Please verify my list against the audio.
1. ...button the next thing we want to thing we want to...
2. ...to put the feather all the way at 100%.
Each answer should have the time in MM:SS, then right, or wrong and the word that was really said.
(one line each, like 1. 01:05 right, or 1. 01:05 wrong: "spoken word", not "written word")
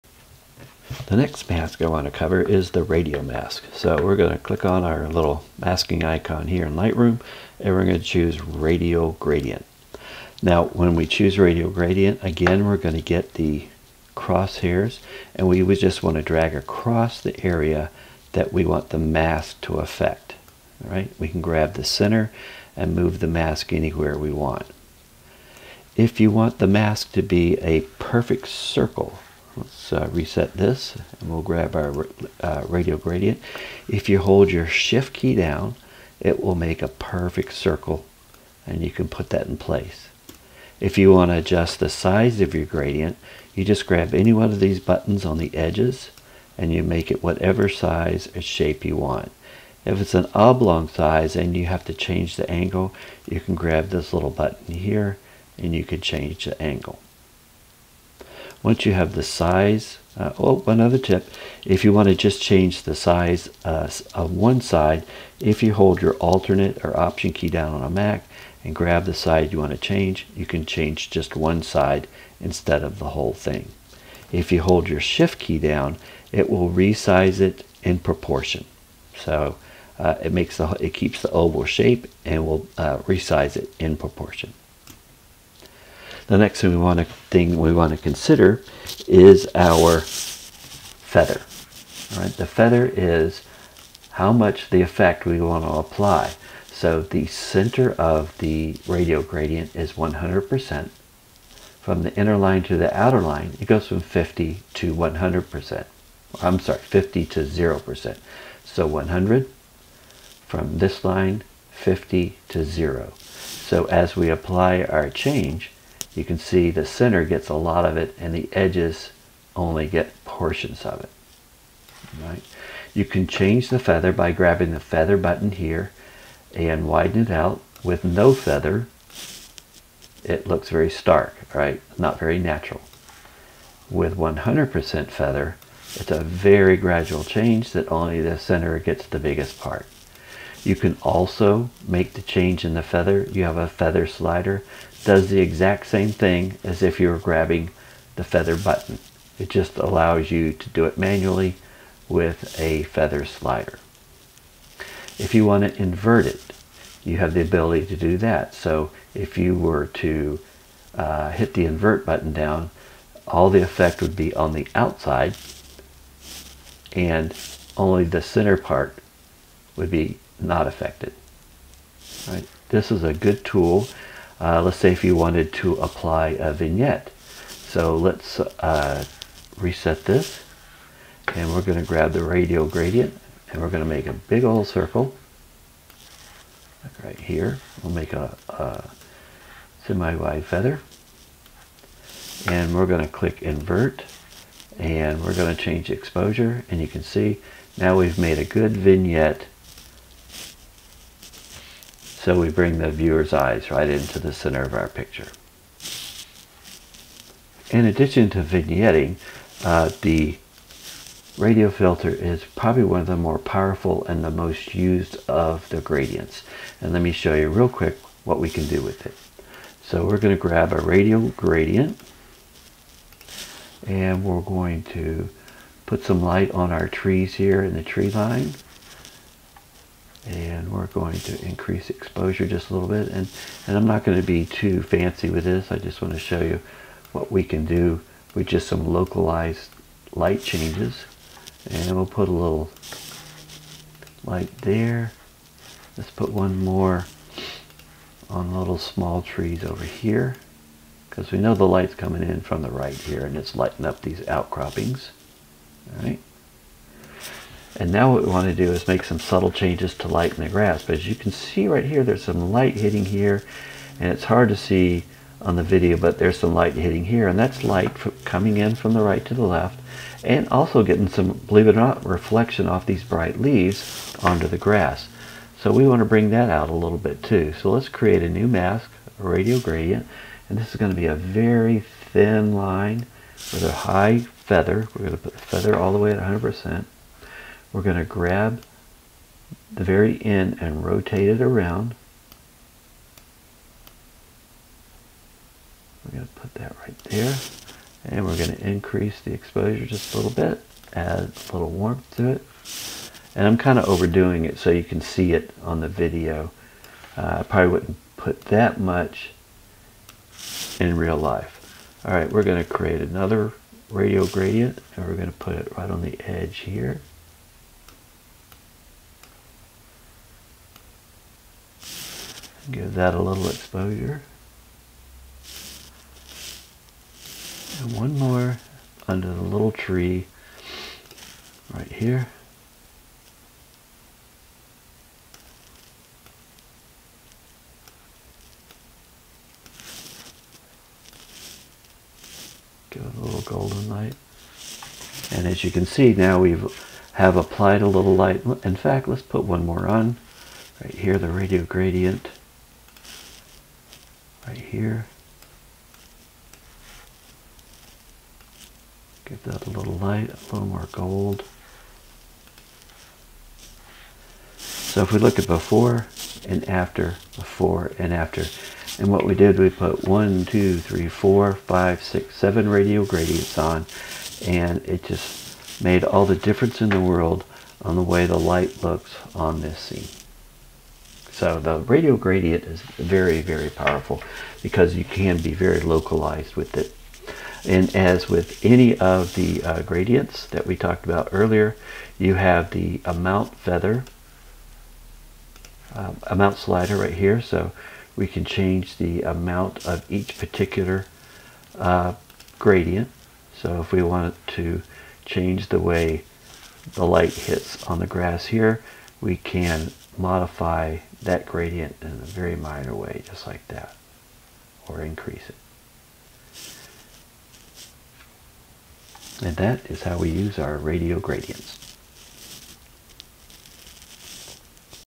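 1. 01:23 wrong: "proportion", not "button"
2. 04:45 right.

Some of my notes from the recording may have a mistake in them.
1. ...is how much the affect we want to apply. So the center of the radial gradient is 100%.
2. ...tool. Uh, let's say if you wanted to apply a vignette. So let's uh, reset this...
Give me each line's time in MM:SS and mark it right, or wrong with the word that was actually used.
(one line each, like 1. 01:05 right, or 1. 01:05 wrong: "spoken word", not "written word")
1. 01:32 wrong: "effect", not "affect"
2. 02:53 right.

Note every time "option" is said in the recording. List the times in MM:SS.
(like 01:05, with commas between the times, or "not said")
01:06.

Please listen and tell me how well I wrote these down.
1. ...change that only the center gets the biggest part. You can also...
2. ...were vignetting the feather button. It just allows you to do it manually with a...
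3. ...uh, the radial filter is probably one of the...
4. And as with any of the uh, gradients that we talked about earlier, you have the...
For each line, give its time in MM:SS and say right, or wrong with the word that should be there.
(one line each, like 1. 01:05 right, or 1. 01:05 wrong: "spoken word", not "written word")
1. 02:17 right
2. 02:27 wrong: "grabbing", not "vignetting"
3. 03:29 right
4. 06:27 right.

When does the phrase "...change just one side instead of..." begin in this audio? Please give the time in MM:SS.
01:10.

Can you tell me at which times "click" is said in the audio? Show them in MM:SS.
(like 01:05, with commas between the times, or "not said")
00:04, 03:13.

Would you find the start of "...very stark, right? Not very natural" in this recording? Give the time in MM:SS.
02:10.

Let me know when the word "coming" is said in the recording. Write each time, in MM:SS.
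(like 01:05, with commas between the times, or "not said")
04:11, 04:28.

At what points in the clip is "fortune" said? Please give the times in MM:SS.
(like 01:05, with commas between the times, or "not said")
not said.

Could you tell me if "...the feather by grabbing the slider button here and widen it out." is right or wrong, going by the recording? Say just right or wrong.
wrong.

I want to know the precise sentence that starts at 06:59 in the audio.
And that is how we use our radial gradients.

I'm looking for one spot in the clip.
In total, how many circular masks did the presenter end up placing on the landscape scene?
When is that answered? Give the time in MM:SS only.
06:12.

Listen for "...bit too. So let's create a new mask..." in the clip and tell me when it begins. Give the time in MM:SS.
04:36.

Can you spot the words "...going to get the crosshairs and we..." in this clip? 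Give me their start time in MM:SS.
00:12.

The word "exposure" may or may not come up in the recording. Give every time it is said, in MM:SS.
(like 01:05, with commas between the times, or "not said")
03:15, 03:51, 04:59, 05:23.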